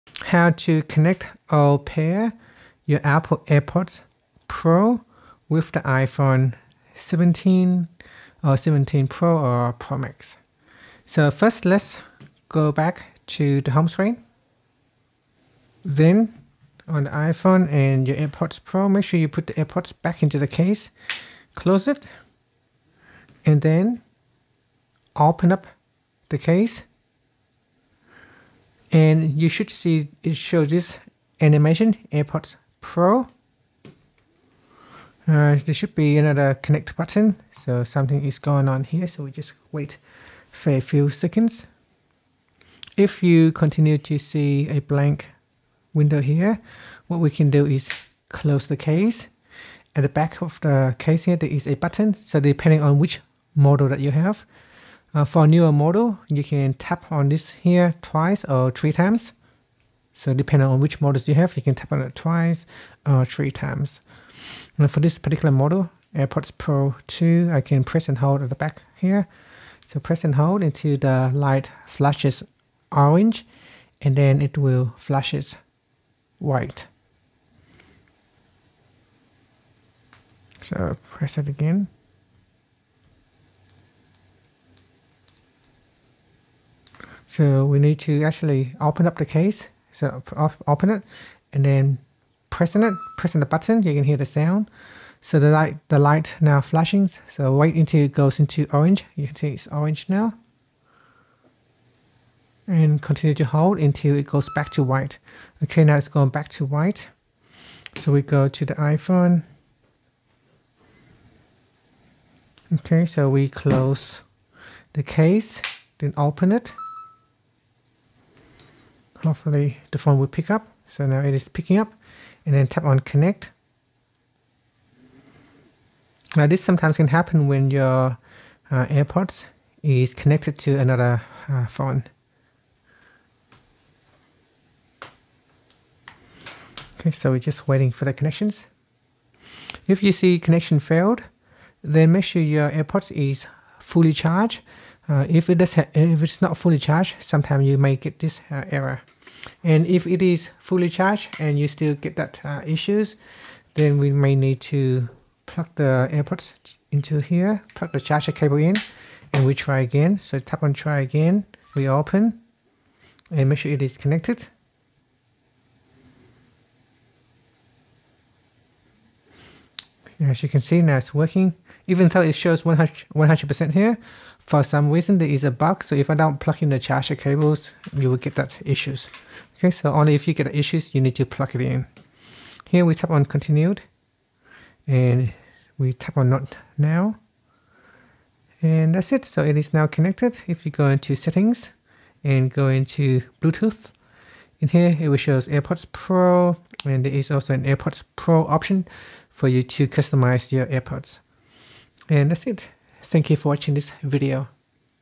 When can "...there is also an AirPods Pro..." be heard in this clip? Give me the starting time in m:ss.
3:17.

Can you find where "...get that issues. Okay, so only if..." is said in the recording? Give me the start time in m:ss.
2:58.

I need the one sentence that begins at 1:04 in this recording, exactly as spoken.
Now for this particular model, AirPods Pro 2, I can press and hold at the back here.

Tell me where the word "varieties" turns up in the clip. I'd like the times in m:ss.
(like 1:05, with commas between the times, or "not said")
not said.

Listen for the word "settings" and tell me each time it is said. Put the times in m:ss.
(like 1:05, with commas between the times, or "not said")
3:11.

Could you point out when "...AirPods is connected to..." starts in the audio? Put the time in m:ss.
2:08.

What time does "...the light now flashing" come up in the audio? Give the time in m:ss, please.
1:35.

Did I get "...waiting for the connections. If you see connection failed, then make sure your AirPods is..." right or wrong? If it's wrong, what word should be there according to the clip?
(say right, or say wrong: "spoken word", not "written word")
right.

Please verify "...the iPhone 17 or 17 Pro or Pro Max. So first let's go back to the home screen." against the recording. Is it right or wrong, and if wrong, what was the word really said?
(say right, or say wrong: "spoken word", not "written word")
right.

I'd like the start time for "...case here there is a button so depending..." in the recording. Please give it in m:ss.
0:50.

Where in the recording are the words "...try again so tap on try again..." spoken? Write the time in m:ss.
2:39.